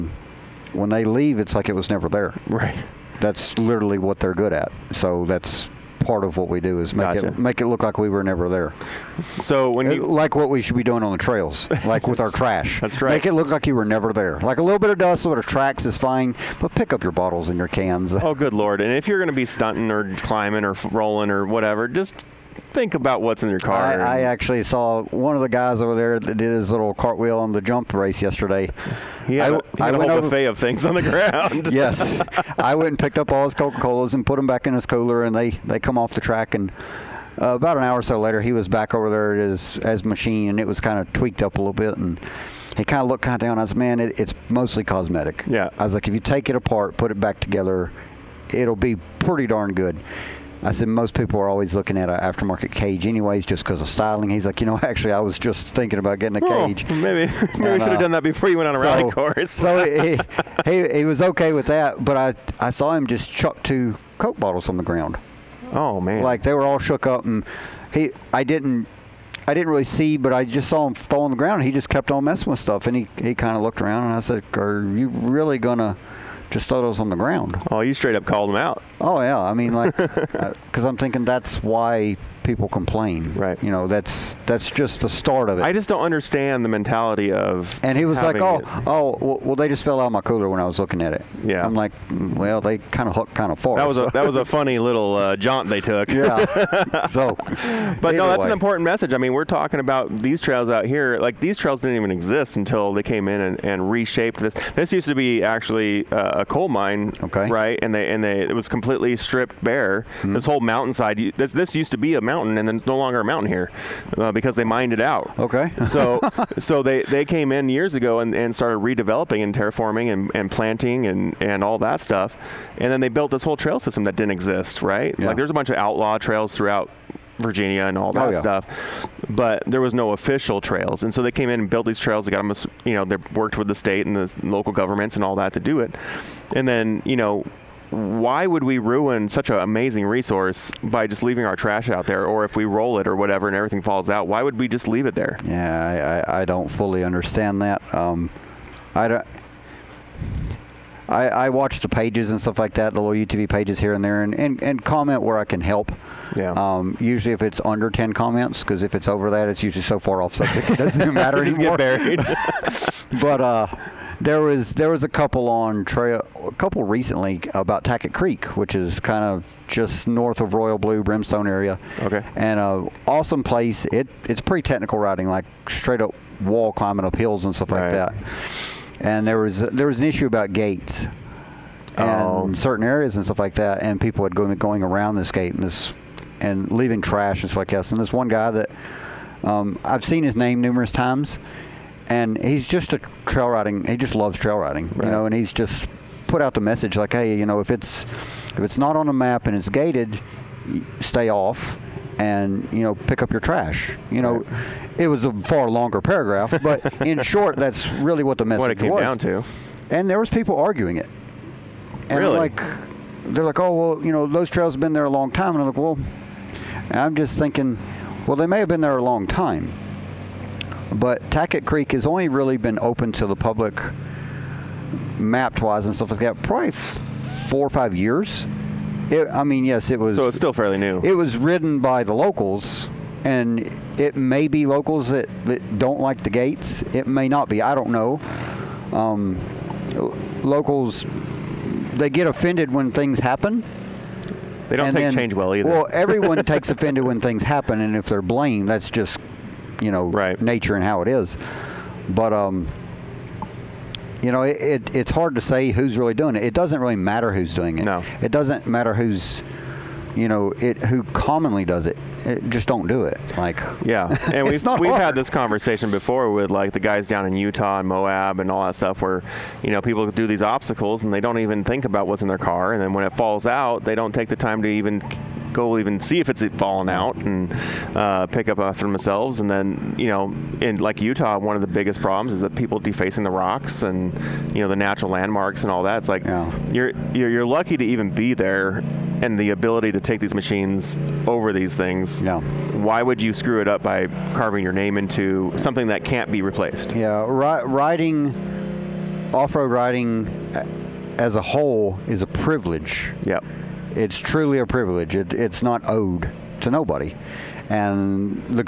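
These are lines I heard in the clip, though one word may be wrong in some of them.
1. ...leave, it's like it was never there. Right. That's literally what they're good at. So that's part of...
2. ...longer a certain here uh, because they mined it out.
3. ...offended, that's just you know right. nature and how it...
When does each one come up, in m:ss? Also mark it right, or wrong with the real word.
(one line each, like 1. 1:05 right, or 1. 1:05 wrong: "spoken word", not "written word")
1. 0:01 right
2. 1:52 wrong: "mountain", not "certain"
3. 4:08 wrong: "blamed", not "offended".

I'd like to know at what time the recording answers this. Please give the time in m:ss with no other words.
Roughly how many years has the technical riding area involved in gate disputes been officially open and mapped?
3:46.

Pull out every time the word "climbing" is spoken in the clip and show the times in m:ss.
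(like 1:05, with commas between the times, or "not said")
0:20, 2:56.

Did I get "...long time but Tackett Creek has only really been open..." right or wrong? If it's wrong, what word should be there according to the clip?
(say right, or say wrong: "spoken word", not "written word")
right.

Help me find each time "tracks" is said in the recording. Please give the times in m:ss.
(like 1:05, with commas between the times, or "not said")
0:15, 0:36.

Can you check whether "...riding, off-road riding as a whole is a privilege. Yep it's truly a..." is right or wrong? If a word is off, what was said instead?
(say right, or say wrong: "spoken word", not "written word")
right.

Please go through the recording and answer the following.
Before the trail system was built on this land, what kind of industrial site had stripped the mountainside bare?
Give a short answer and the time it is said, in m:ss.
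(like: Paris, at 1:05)
A coal mine, at 1:46.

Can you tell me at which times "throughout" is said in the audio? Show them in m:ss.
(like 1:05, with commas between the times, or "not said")
2:06.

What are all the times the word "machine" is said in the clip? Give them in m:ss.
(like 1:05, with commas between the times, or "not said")
0:40, 4:50.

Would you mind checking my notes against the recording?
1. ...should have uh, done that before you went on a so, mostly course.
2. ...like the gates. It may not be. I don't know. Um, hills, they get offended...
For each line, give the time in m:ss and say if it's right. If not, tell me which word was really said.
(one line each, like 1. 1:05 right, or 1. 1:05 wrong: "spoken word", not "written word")
1. 0:57 wrong: "rally", not "mostly"
2. 3:55 wrong: "locals", not "hills".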